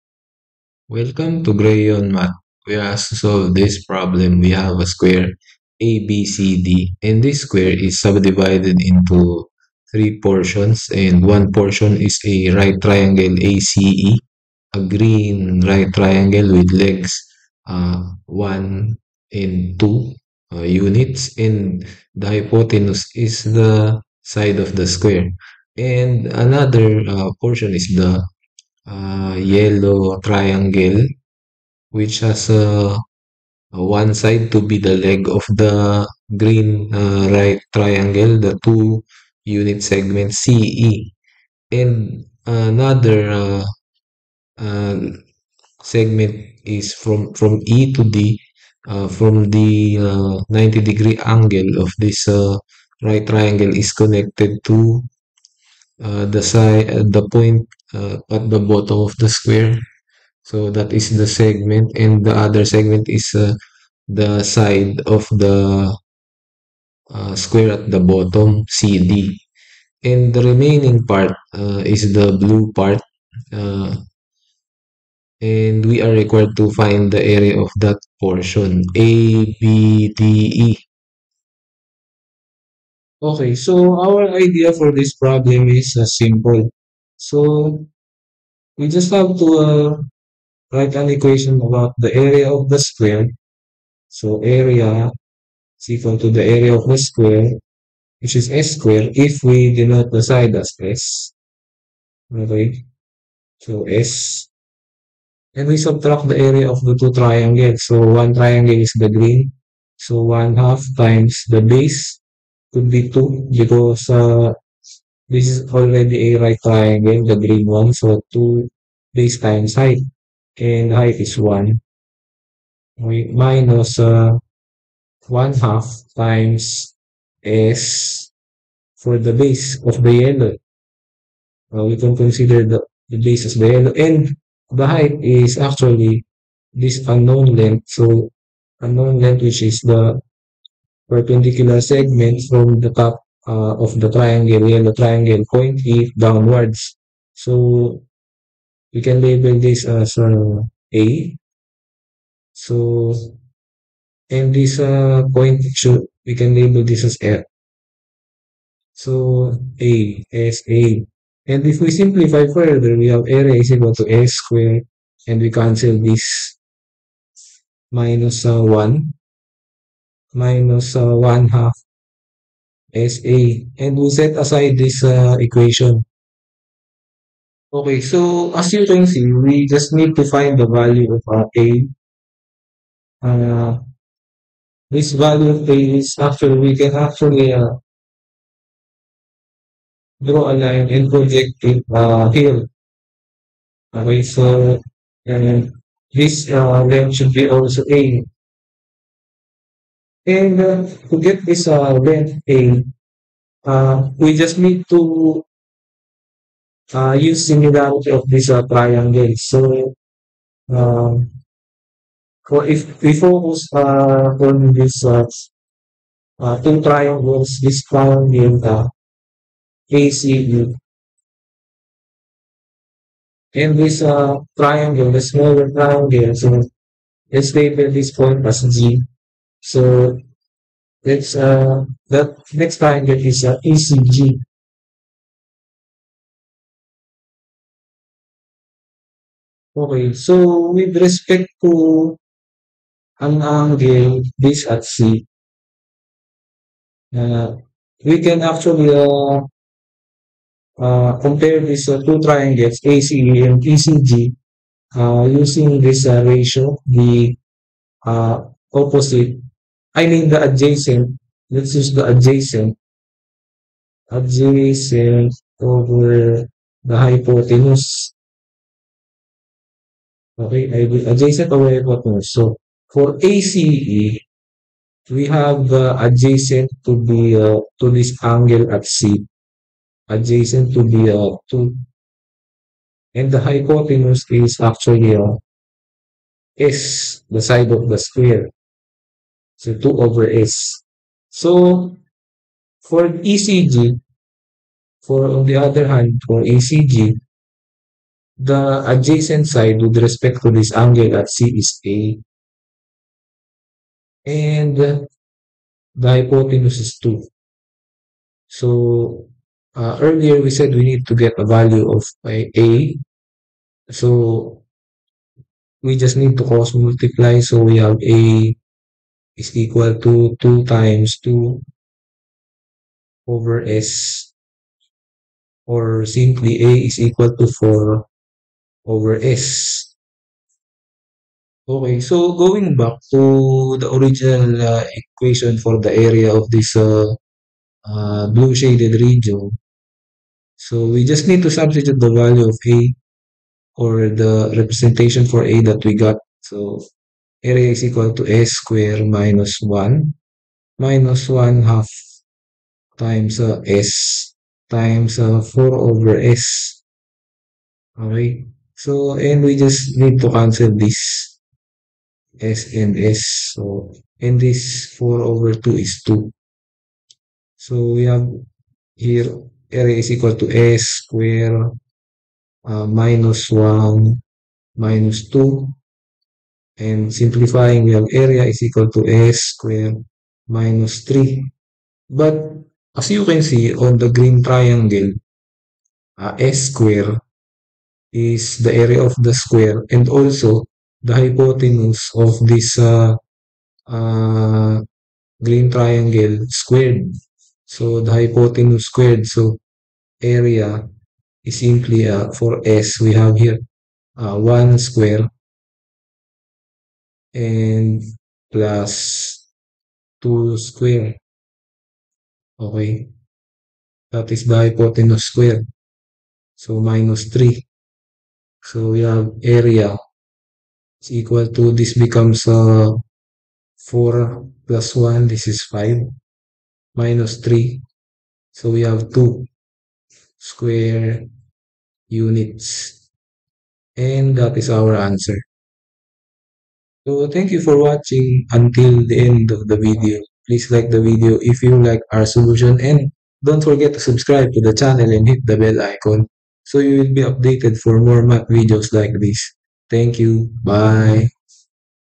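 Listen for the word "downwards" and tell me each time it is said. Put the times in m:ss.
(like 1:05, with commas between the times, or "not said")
2:26.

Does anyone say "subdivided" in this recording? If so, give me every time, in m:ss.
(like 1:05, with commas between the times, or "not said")
0:08.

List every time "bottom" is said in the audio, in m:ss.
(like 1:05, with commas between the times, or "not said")
0:58, 1:07.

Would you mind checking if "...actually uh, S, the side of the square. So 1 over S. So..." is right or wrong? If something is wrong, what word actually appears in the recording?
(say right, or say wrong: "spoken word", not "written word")
wrong: "2", not "1".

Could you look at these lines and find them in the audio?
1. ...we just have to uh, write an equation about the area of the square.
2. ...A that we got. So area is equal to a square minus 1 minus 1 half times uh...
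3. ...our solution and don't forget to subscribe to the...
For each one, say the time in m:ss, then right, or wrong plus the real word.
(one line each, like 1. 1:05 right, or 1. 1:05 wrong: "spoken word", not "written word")
1. 1:28 right
2. 5:45 right
3. 7:22 right.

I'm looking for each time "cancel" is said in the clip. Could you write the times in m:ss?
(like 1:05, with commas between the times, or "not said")
2:45, 6:00.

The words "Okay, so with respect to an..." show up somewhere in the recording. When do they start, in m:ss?
3:59.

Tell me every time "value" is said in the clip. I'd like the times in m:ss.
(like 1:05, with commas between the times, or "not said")
3:00, 3:05, 5:11, 5:42.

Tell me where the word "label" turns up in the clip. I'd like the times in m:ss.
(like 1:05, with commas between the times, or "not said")
2:29, 2:36, 3:47.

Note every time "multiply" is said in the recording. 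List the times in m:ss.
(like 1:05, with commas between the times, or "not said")
5:16.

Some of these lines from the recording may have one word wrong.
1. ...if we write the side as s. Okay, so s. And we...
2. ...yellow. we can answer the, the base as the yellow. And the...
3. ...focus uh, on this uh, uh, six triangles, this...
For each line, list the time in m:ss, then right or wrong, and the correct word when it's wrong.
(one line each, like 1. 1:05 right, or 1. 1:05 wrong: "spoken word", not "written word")
1. 1:39 wrong: "denote", not "write"
2. 2:10 wrong: "consider", not "answer"
3. 3:33 wrong: "two", not "six".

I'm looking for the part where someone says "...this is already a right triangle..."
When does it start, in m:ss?
1:55.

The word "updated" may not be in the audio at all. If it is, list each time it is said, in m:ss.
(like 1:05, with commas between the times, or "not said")
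7:27.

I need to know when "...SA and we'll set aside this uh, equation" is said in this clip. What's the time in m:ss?
2:52.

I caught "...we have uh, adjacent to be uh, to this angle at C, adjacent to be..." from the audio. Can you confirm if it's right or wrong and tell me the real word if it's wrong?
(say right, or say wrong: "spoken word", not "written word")
right.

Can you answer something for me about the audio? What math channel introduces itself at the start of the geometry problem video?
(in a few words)
GrayYeon Math.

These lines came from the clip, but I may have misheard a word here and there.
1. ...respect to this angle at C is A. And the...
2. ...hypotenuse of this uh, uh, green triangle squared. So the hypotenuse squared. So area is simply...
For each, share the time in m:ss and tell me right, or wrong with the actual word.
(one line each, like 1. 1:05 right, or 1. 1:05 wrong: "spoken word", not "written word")
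1. 5:00 right
2. 6:31 right.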